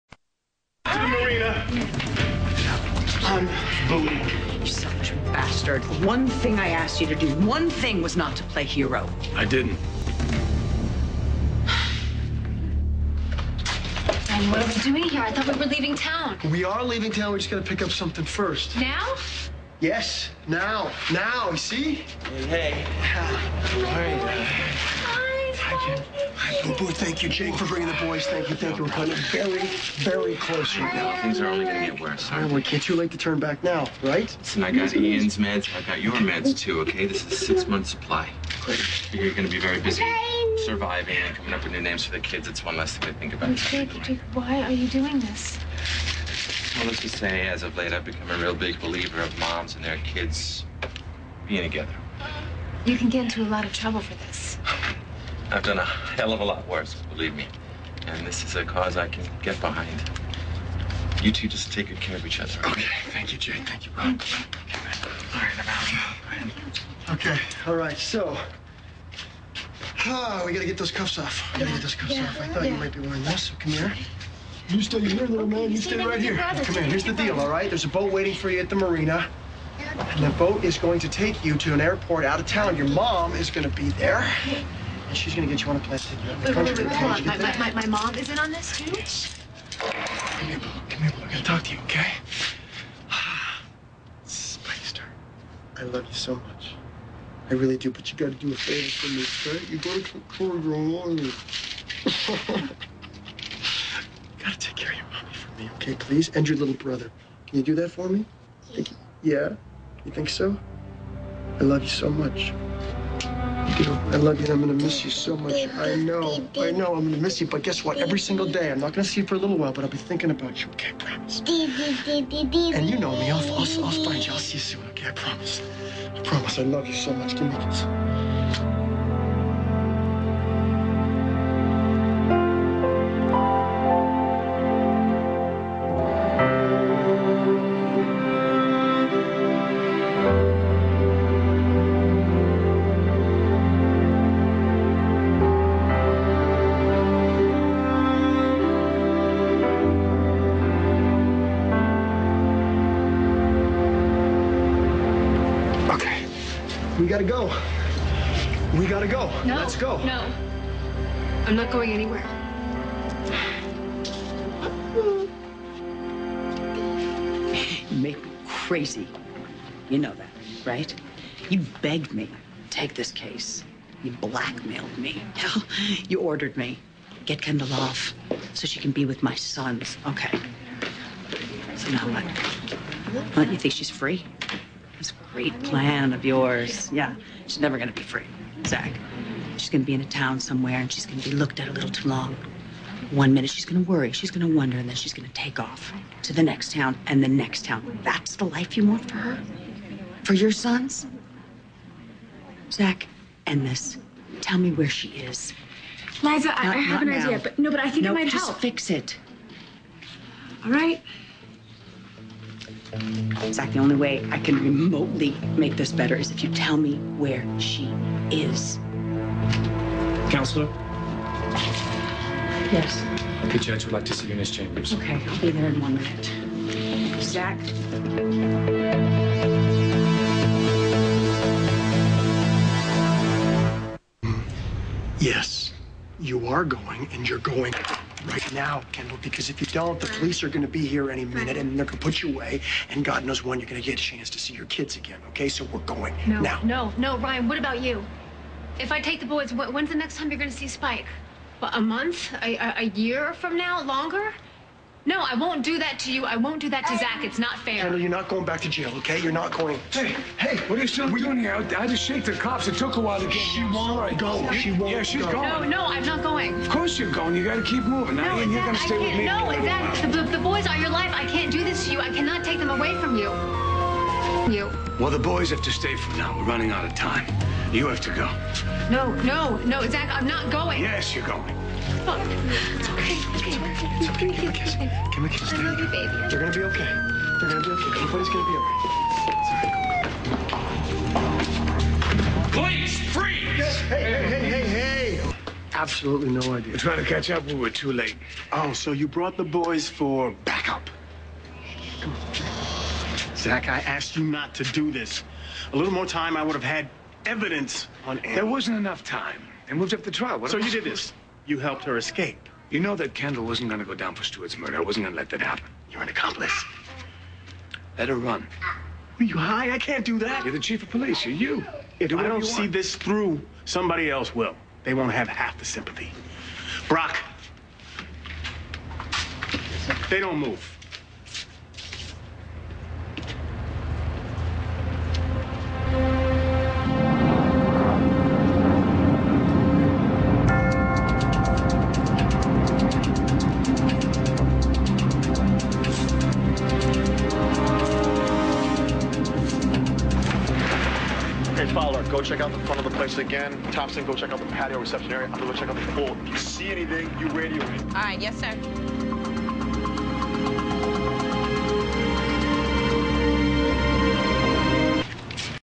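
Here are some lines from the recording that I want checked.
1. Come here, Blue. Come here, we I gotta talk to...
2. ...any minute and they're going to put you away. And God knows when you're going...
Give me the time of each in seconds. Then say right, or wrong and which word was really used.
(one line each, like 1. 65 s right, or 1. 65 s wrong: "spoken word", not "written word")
1. 89 s right
2. 241 s right.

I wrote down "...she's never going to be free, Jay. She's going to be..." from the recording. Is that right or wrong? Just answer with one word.
wrong.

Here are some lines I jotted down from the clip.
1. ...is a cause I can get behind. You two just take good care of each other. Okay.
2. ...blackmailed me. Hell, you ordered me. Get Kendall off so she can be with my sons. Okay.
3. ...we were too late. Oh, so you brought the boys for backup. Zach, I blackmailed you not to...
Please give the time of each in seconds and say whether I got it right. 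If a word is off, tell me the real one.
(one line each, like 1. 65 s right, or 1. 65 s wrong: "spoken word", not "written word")
1. 58 s right
2. 174 s right
3. 297 s wrong: "asked", not "blackmailed".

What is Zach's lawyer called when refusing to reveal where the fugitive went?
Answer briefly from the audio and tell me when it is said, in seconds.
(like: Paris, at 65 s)
Liza, at 206 s.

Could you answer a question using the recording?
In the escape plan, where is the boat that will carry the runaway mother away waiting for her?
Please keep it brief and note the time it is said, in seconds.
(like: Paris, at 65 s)
the marina, at 78 s.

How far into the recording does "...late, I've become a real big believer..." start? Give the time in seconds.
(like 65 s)
47 s.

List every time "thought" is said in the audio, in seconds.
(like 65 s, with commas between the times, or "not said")
15 s, 72 s.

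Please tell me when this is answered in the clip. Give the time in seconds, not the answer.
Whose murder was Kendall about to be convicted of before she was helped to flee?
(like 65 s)
314 s.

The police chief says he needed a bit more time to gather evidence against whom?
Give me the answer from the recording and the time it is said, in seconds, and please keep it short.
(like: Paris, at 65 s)
Annie, at 308 s.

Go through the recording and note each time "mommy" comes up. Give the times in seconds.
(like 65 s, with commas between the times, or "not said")
100 s, 105 s.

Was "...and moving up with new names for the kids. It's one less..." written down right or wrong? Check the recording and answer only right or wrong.
wrong.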